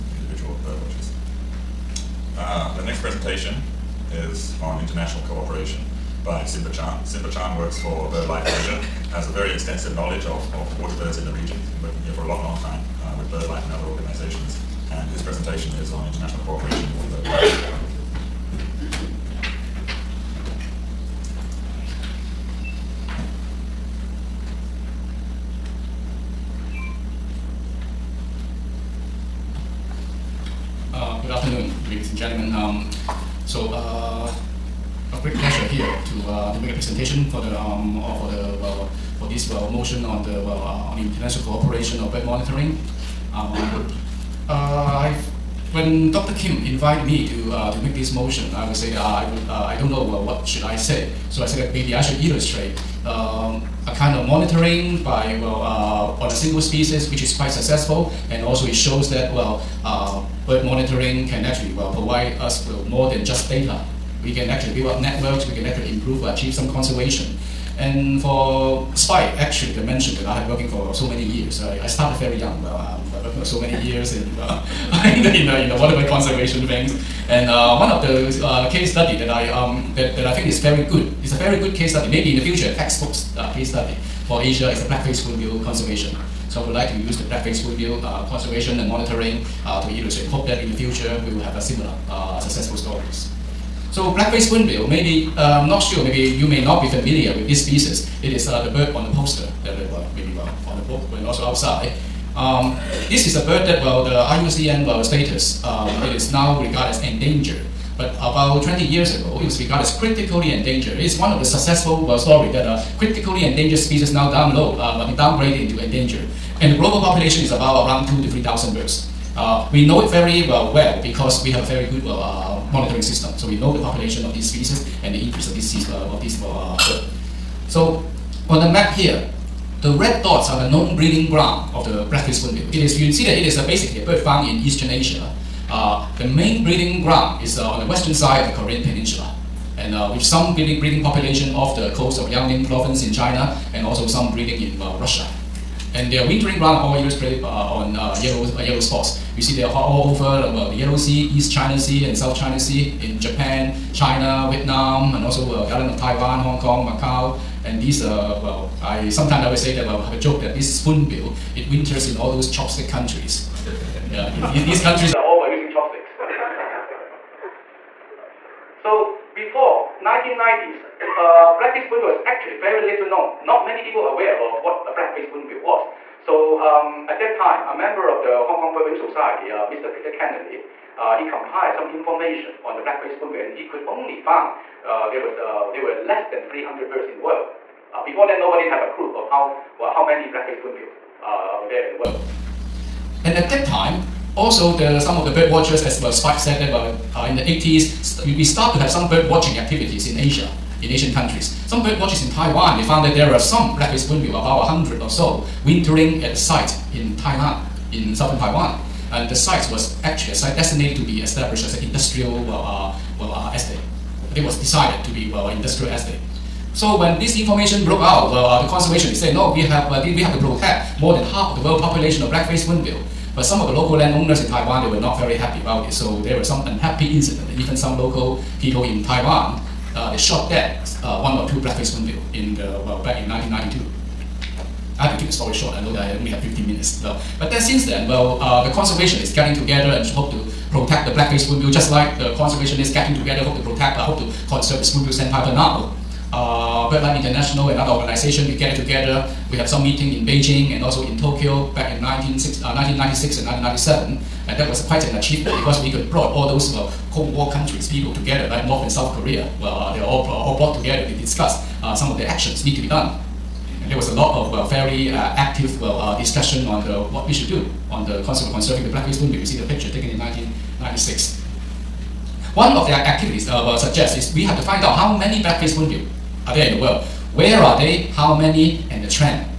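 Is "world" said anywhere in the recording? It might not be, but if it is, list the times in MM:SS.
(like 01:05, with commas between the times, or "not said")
03:07, 03:11, 03:41, 04:36.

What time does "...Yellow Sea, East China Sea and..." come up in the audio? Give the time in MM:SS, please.
02:30.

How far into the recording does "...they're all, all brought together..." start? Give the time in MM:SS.
04:19.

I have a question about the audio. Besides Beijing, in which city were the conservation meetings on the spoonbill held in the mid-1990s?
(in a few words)
Tokyo.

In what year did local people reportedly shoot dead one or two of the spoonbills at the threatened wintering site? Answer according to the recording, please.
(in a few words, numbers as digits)
1992.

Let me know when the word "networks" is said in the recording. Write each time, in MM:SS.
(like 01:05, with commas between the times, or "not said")
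01:05.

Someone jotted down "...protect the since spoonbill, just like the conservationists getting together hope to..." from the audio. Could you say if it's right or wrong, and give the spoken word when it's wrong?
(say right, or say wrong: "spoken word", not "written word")
wrong: "blackface", not "since".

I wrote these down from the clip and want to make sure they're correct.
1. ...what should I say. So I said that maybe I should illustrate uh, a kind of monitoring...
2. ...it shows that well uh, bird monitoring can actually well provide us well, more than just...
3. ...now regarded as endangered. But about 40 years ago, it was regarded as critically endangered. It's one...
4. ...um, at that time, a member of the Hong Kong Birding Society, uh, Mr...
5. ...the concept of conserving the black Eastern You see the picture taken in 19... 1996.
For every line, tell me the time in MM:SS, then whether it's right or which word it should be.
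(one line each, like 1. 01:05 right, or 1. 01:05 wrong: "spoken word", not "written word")
1. 00:50 right
2. 00:58 right
3. 01:46 wrong: "20", not "40"
4. 02:56 right
5. 04:28 wrong: "Sea", not "Eastern".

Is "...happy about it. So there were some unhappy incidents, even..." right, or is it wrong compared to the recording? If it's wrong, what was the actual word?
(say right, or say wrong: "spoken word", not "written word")
right.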